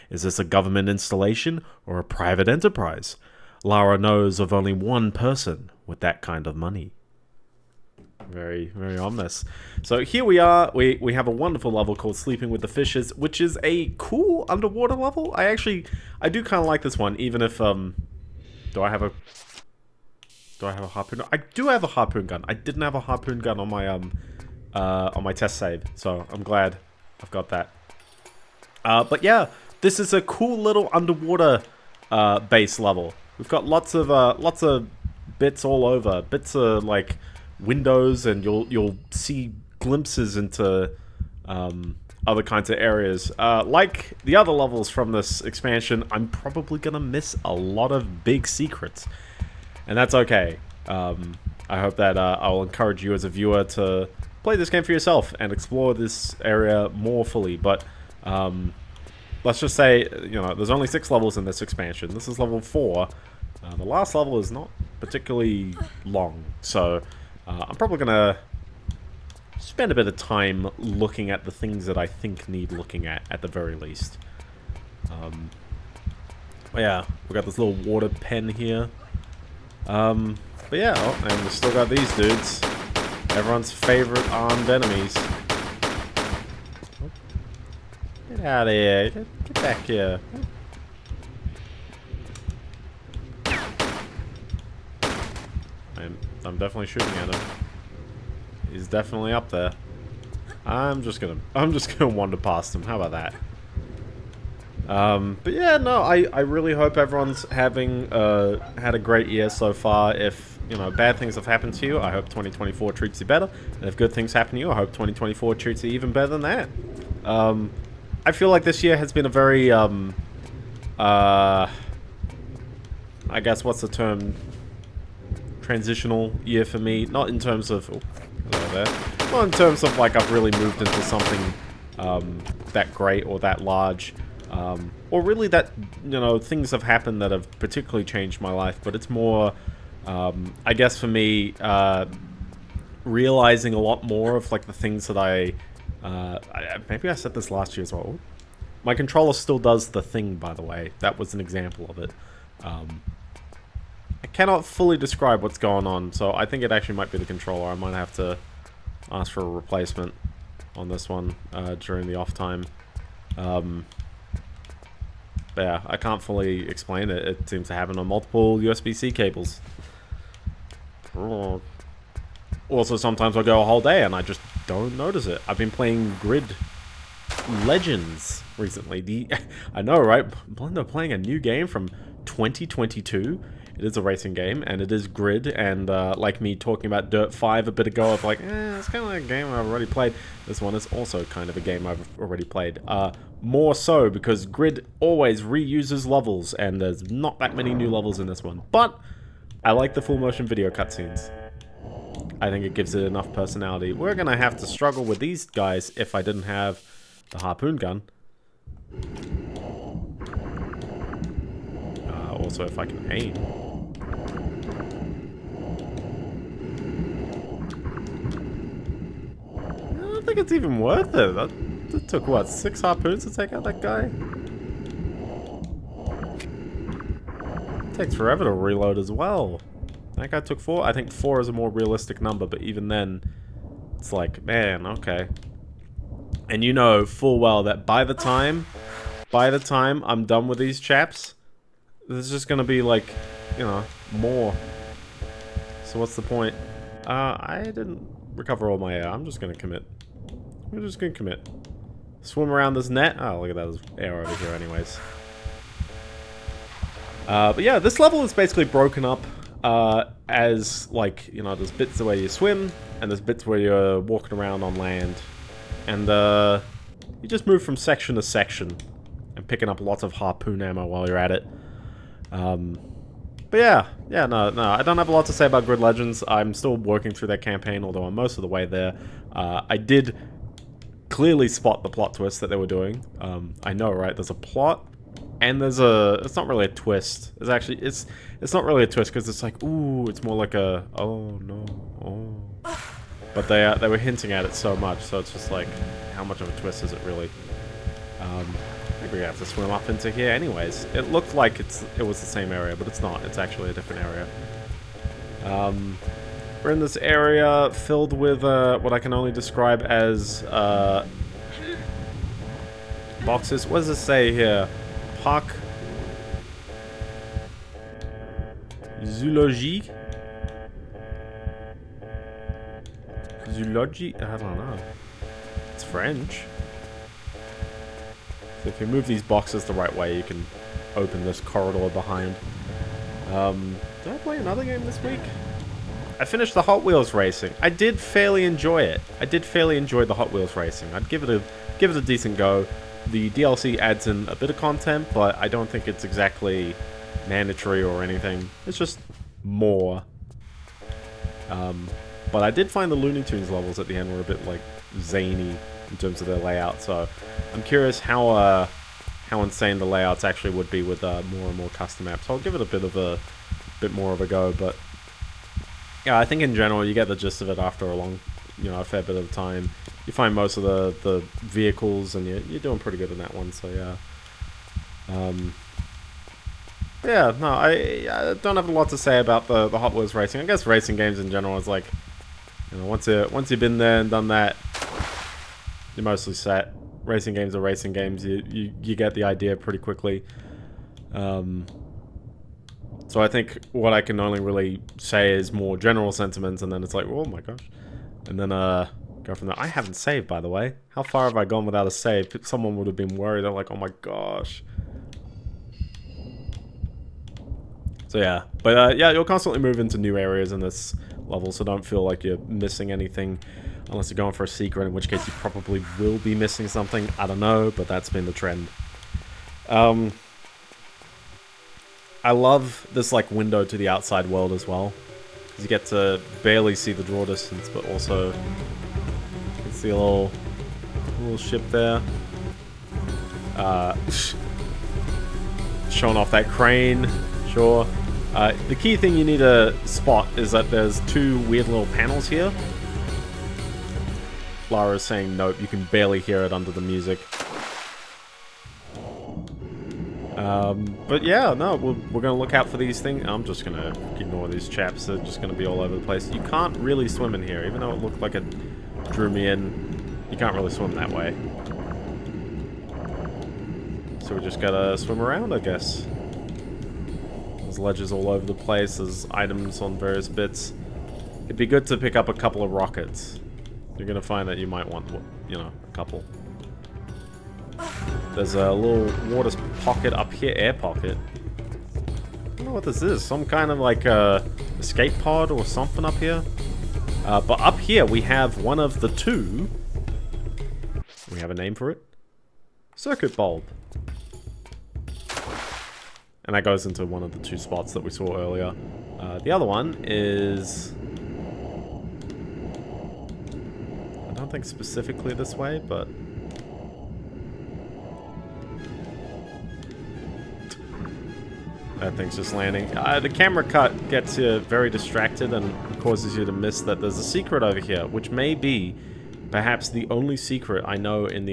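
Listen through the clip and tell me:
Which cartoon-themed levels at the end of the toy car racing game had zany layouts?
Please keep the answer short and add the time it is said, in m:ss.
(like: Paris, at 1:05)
Looney Tunes, at 5:52.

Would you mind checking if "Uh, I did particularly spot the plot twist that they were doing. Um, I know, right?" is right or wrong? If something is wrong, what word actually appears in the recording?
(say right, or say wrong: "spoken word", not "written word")
wrong: "clearly", not "particularly".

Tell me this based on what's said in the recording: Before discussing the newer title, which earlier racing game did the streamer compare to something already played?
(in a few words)
Dirt 5.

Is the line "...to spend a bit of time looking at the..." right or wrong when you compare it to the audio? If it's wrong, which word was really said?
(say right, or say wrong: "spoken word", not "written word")
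right.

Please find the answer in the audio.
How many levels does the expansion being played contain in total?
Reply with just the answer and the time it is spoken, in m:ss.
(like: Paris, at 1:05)
6, at 1:00.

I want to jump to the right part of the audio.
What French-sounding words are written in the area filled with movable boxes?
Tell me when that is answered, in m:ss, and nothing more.
5:15.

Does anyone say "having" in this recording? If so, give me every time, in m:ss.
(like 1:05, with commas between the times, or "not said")
1:47.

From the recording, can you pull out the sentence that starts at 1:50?
If you know bad things have happened to you, I hope 2024 treats you better.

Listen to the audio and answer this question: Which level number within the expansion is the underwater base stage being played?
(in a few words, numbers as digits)
4.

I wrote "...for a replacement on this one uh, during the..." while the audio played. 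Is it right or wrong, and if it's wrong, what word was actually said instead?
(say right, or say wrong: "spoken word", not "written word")
right.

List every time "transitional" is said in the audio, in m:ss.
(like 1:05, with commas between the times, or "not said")
2:05.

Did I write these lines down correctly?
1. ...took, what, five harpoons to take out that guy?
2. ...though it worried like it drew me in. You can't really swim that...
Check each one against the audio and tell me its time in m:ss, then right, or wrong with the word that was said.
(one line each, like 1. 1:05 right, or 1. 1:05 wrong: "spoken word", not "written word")
1. 3:42 wrong: "six", not "five"
2. 7:37 wrong: "looked", not "worried".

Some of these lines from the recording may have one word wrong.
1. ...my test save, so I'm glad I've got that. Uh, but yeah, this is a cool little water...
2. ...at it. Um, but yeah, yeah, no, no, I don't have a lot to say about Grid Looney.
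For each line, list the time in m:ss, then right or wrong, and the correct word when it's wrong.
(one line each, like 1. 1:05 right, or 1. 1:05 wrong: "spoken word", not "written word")
1. 0:25 wrong: "underwater", not "water"
2. 4:31 wrong: "Legends", not "Looney".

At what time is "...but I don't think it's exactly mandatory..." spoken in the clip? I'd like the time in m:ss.
5:45.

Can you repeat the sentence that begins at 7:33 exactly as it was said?
I'm just going to ignore these chaps.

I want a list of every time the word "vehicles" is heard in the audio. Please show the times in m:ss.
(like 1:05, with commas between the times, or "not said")
6:11.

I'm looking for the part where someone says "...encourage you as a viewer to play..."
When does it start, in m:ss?
0:52.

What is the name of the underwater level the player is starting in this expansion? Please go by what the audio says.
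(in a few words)
Sleeping with the Fishes.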